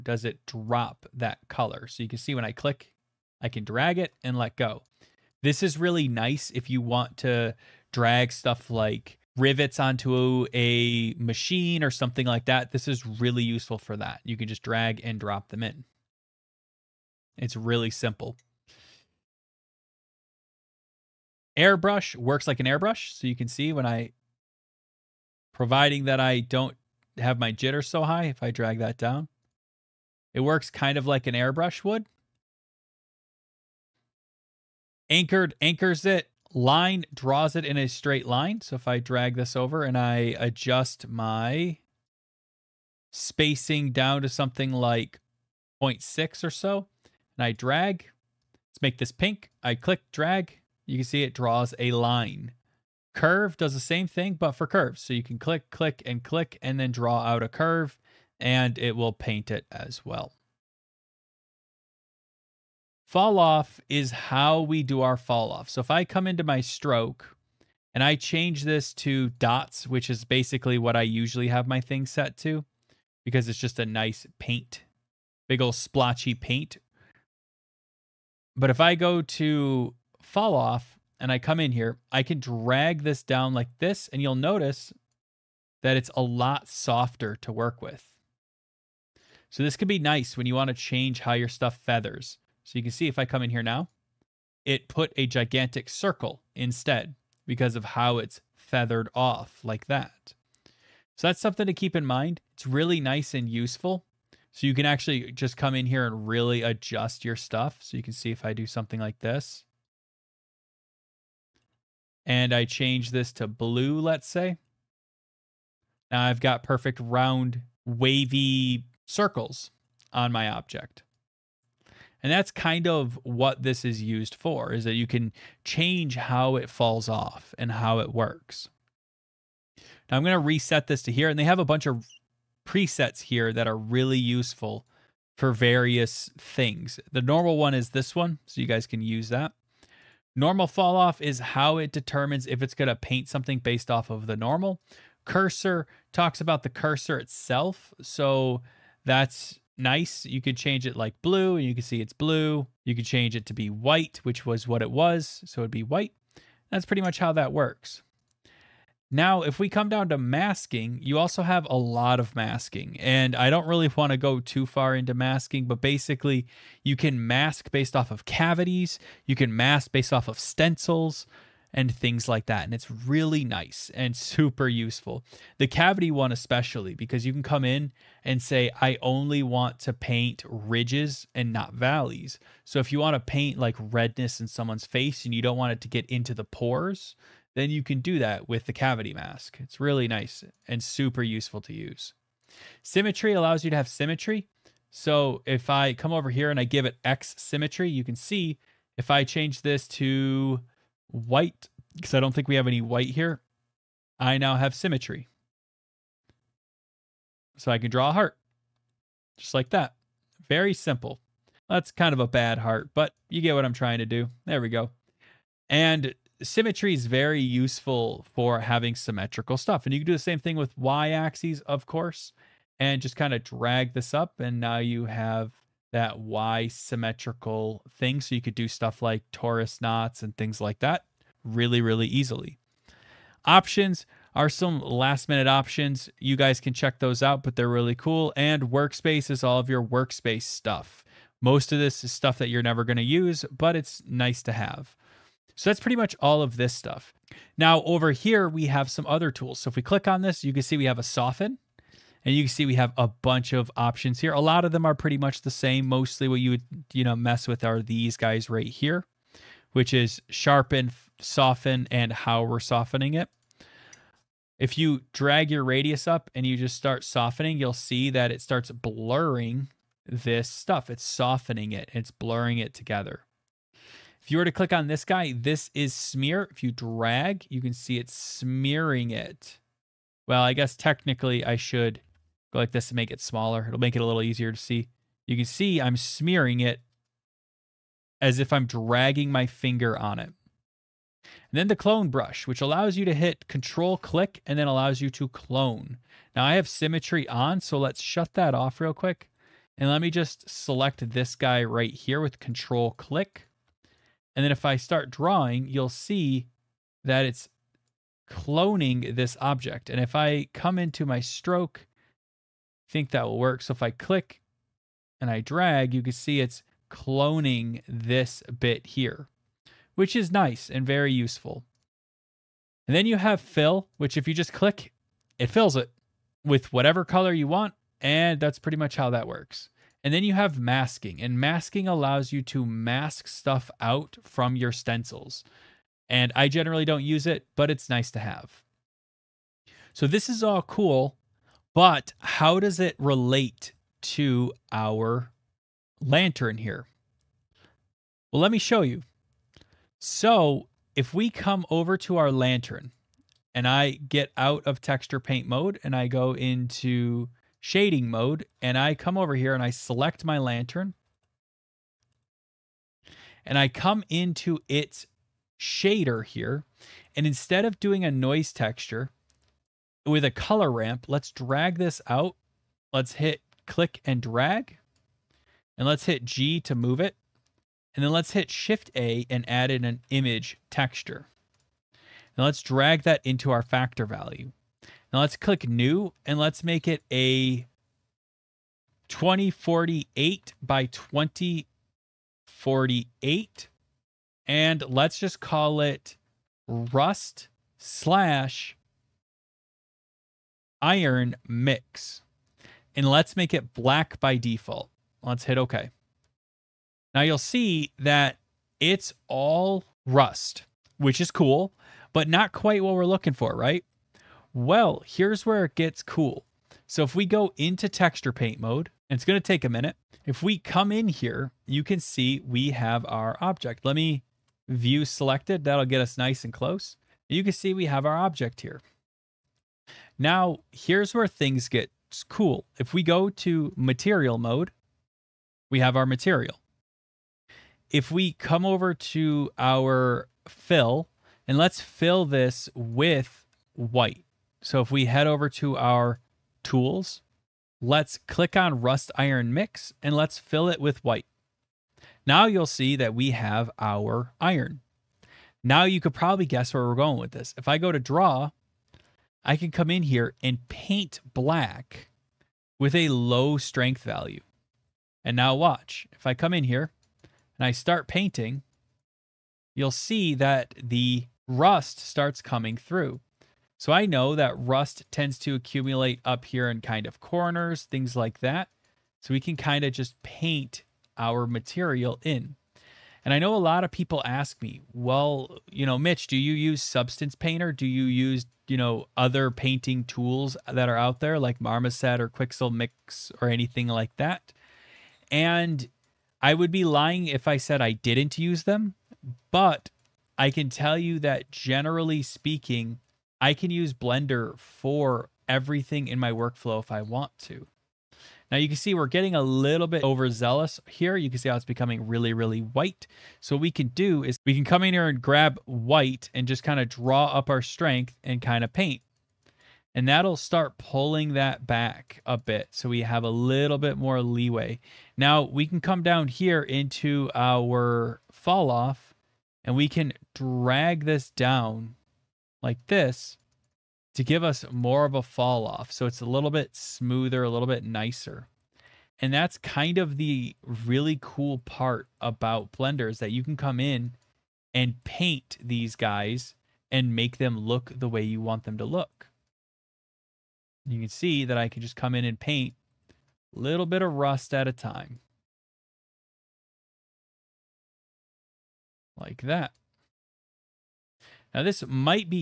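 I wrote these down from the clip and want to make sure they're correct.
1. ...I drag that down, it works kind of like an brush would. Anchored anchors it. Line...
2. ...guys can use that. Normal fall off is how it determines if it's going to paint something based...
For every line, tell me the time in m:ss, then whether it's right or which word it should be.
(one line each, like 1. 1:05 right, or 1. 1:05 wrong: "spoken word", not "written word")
1. 0:28 wrong: "airbrush", not "brush"
2. 2:18 right.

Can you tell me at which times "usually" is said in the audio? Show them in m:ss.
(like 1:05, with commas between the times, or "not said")
1:11.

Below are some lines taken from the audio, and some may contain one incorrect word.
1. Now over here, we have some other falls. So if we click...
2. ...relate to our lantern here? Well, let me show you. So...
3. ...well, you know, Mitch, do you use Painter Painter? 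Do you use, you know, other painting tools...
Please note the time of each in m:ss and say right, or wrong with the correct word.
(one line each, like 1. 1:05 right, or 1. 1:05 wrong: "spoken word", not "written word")
1. 4:07 wrong: "tools", not "falls"
2. 5:42 right
3. 8:04 wrong: "Substance", not "Painter".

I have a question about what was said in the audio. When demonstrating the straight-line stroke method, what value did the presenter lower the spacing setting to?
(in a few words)
0.6.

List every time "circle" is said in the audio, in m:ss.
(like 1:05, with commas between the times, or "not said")
1:35, 1:59.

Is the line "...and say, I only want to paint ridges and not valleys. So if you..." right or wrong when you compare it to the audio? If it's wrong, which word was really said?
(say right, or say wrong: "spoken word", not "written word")
right.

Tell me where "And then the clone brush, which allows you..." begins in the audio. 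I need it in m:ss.
4:51.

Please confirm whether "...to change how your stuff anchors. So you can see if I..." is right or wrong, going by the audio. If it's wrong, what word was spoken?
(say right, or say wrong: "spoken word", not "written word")
wrong: "feathers", not "anchors".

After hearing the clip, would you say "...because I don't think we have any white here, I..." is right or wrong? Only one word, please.
right.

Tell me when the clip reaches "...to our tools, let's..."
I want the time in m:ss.
7:25.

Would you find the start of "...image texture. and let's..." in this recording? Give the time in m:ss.
6:20.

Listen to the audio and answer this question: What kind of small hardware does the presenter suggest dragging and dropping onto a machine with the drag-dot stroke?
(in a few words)
Rivets.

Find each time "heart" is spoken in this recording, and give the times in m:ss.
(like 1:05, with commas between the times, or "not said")
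3:28, 3:32.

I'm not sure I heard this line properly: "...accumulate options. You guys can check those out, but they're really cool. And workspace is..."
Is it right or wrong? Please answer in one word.
wrong.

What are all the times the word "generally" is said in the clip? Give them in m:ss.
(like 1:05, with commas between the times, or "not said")
5:36, 8:21.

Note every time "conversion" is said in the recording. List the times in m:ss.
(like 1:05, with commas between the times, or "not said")
not said.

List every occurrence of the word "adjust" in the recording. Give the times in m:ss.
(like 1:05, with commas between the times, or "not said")
0:40, 1:46.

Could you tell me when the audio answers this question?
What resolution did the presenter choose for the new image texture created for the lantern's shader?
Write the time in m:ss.
6:29.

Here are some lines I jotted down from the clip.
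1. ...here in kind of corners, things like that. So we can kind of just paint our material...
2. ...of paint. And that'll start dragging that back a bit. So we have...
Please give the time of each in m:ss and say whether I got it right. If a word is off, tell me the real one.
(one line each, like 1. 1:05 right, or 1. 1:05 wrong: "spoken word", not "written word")
1. 7:56 right
2. 8:38 wrong: "pulling", not "dragging".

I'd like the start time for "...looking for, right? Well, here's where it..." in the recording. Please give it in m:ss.
6:53.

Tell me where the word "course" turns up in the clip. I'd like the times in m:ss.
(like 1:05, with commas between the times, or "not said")
3:41.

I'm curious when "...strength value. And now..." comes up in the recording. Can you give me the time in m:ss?
7:43.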